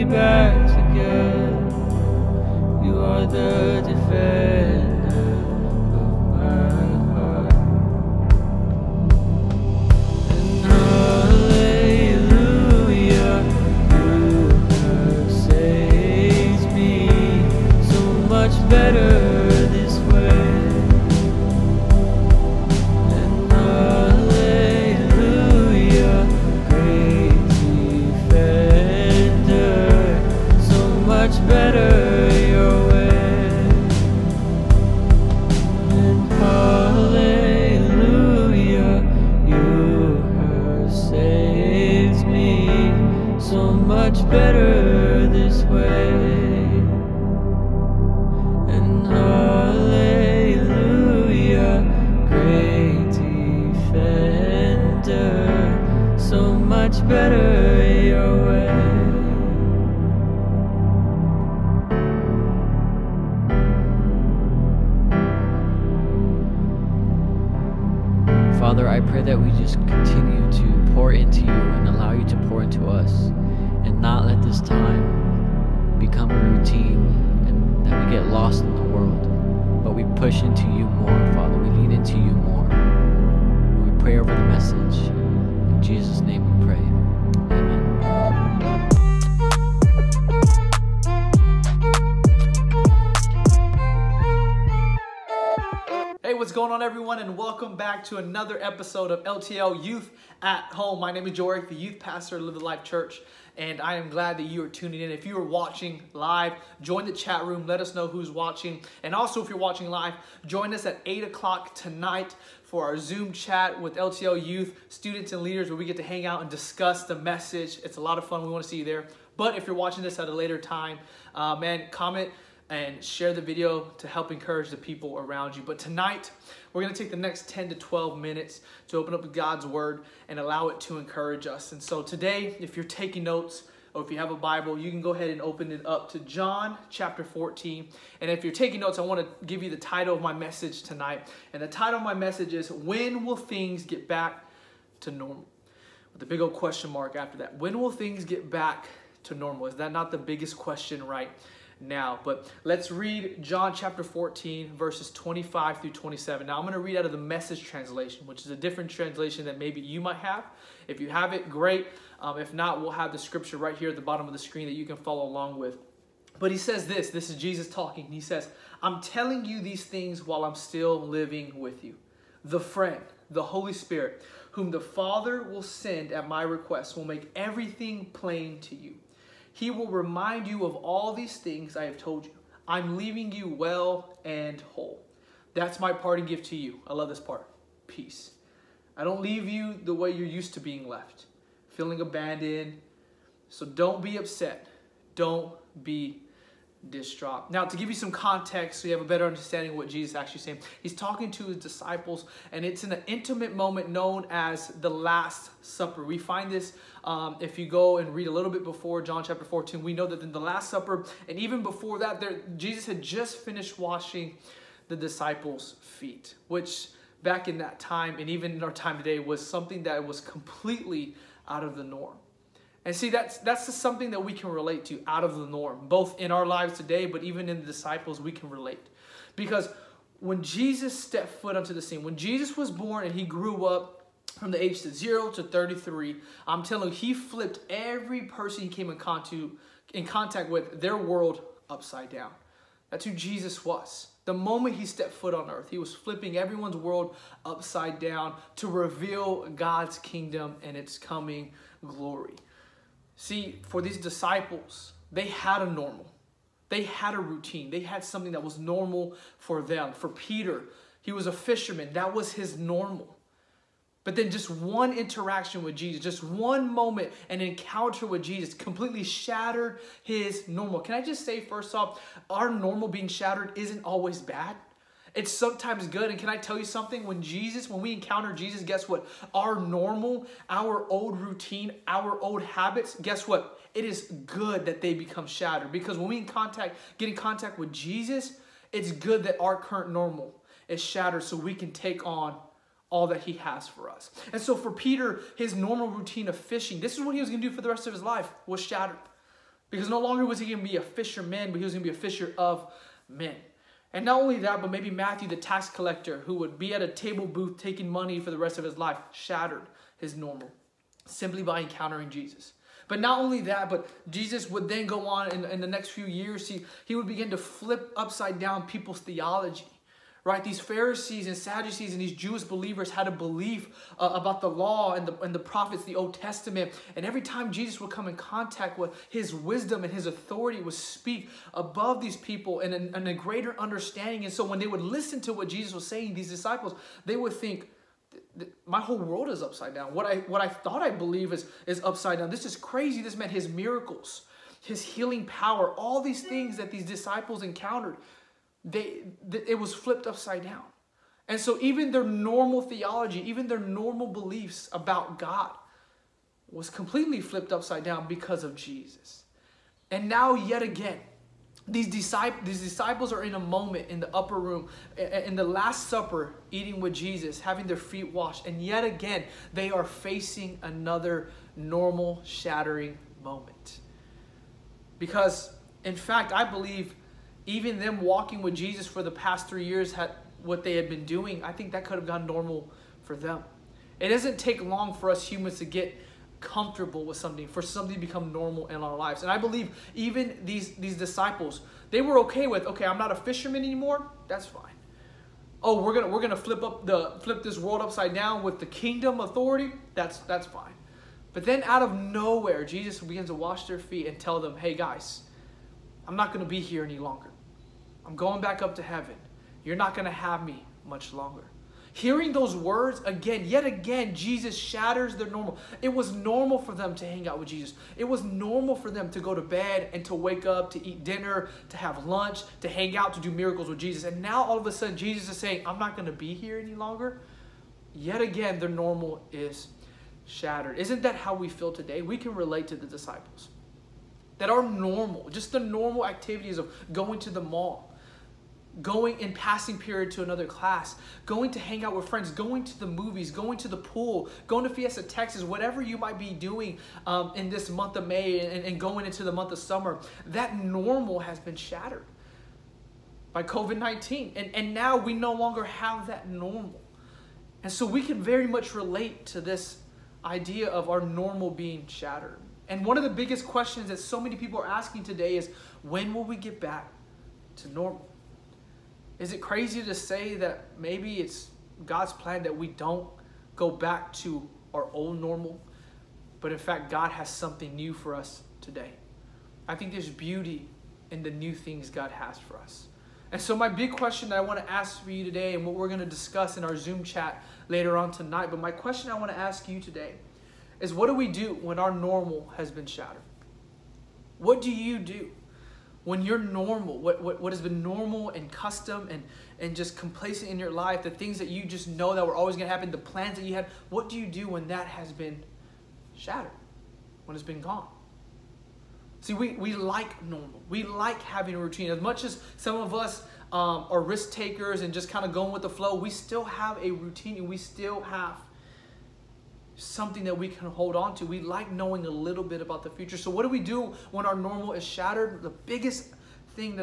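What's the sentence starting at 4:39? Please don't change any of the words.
Our normal, our old routine, our old habits, guess what?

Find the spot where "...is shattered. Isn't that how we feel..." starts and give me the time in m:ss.
7:09.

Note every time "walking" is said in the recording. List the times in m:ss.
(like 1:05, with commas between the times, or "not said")
6:17.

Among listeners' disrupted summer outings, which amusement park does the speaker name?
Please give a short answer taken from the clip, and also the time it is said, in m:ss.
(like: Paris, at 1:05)
Fiesta Texas, at 7:24.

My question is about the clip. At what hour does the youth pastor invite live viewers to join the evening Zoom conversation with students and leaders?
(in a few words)
8 o'clock.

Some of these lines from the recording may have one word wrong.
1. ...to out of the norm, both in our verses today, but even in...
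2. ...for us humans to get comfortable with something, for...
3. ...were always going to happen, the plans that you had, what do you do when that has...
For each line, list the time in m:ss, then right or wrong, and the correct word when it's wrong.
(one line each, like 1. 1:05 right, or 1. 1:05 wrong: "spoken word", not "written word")
1. 3:44 wrong: "lives", not "verses"
2. 6:24 right
3. 8:22 right.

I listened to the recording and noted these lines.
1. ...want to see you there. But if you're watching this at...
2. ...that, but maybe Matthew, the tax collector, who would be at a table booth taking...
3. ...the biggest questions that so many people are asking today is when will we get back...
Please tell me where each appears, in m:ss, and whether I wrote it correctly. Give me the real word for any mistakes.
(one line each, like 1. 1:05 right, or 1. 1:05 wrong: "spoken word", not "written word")
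1. 1:58 right
2. 5:04 right
3. 7:43 right.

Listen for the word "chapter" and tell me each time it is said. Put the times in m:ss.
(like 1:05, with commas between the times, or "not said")
2:16, 2:33, 3:29.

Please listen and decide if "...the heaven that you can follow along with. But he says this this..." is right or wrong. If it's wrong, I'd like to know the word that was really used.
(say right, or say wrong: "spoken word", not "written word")
wrong: "screen", not "heaven".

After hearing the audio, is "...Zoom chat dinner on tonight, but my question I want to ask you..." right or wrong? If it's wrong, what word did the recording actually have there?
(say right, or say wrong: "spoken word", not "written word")
wrong: "later", not "dinner".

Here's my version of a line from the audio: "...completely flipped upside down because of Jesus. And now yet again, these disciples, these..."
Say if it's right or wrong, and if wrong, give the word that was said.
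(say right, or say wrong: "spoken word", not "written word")
right.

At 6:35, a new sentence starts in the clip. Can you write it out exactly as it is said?
Oh, we're gonna we're gonna flip up the flip this world upside down with the kingdom authority, that's that's fine.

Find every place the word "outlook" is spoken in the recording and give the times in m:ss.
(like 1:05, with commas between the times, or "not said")
not said.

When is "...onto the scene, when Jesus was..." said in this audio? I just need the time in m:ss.
3:51.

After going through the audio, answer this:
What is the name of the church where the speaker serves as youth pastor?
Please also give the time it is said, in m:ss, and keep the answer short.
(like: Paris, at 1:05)
Live the Life Church, at 1:42.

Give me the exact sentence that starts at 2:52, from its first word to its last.
The friend, the Holy Spirit, whom the Father will send at my request, will make everything plain to you.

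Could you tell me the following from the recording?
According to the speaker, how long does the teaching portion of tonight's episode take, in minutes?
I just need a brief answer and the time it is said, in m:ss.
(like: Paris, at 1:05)
10 to 12 minutes, at 2:07.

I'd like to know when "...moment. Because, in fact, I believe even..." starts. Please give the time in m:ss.
6:13.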